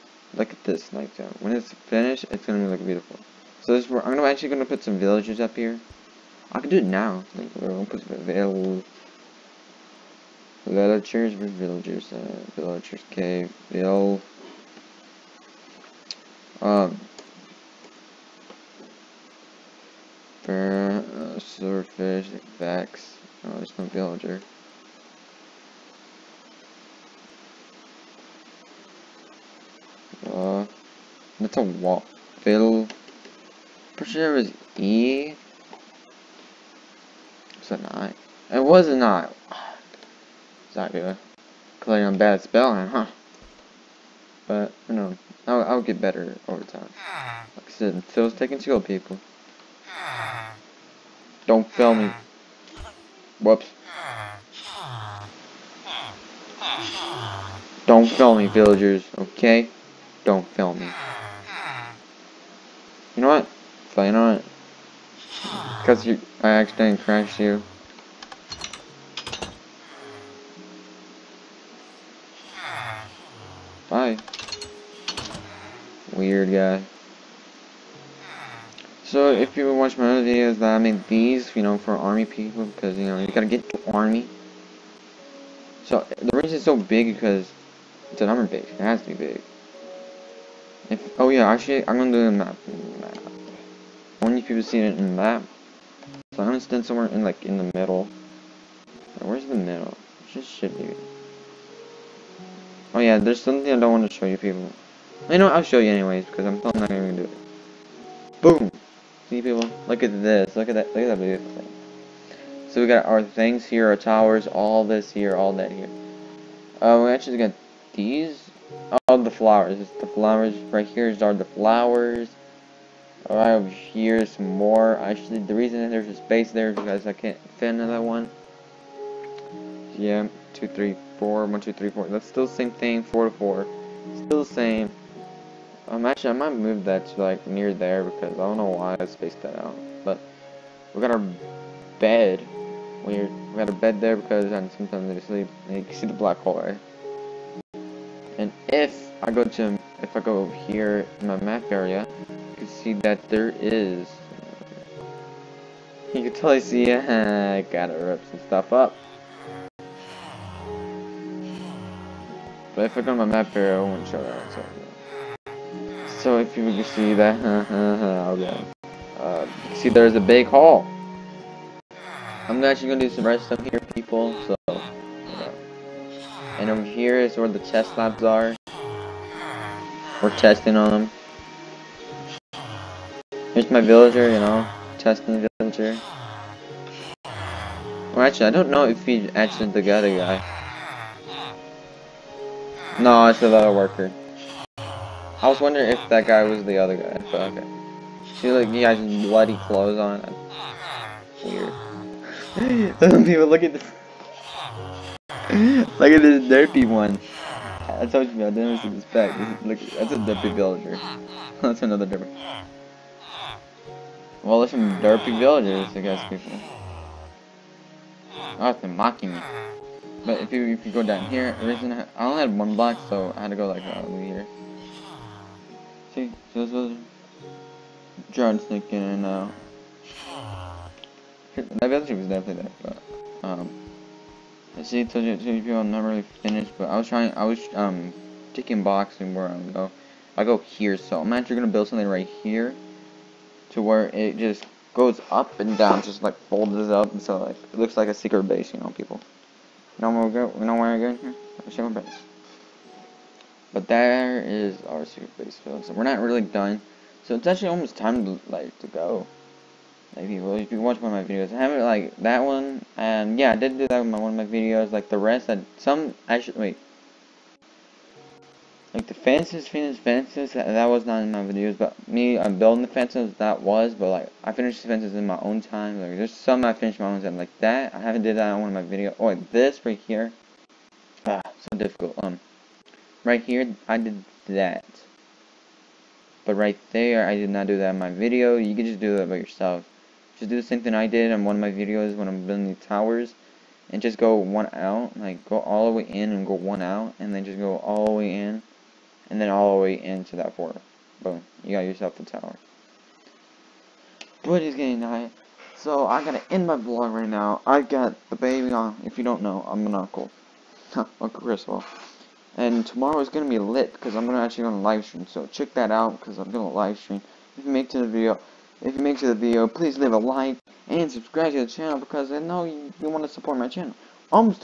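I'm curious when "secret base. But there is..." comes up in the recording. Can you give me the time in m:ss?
4:11.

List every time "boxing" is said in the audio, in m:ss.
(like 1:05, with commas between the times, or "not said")
3:58.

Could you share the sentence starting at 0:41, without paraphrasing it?
Playing I'm bad at spelling, huh?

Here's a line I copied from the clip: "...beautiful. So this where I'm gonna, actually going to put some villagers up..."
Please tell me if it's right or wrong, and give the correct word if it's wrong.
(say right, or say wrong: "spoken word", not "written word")
right.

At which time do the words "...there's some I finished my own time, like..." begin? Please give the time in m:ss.
4:36.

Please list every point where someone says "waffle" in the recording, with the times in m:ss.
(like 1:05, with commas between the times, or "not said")
0:31.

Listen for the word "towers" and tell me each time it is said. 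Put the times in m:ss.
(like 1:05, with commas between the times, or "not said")
1:53, 4:52, 5:02.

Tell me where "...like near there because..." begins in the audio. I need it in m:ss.
2:17.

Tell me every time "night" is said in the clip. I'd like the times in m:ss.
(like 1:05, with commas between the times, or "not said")
0:00, 5:05.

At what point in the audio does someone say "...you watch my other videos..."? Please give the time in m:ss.
1:19.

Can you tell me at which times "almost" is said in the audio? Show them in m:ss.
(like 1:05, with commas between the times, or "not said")
4:17.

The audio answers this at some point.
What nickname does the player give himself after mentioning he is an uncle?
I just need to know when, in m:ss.
5:10.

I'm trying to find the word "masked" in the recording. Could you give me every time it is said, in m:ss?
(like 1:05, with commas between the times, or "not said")
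not said.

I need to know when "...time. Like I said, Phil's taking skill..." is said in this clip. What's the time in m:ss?
0:46.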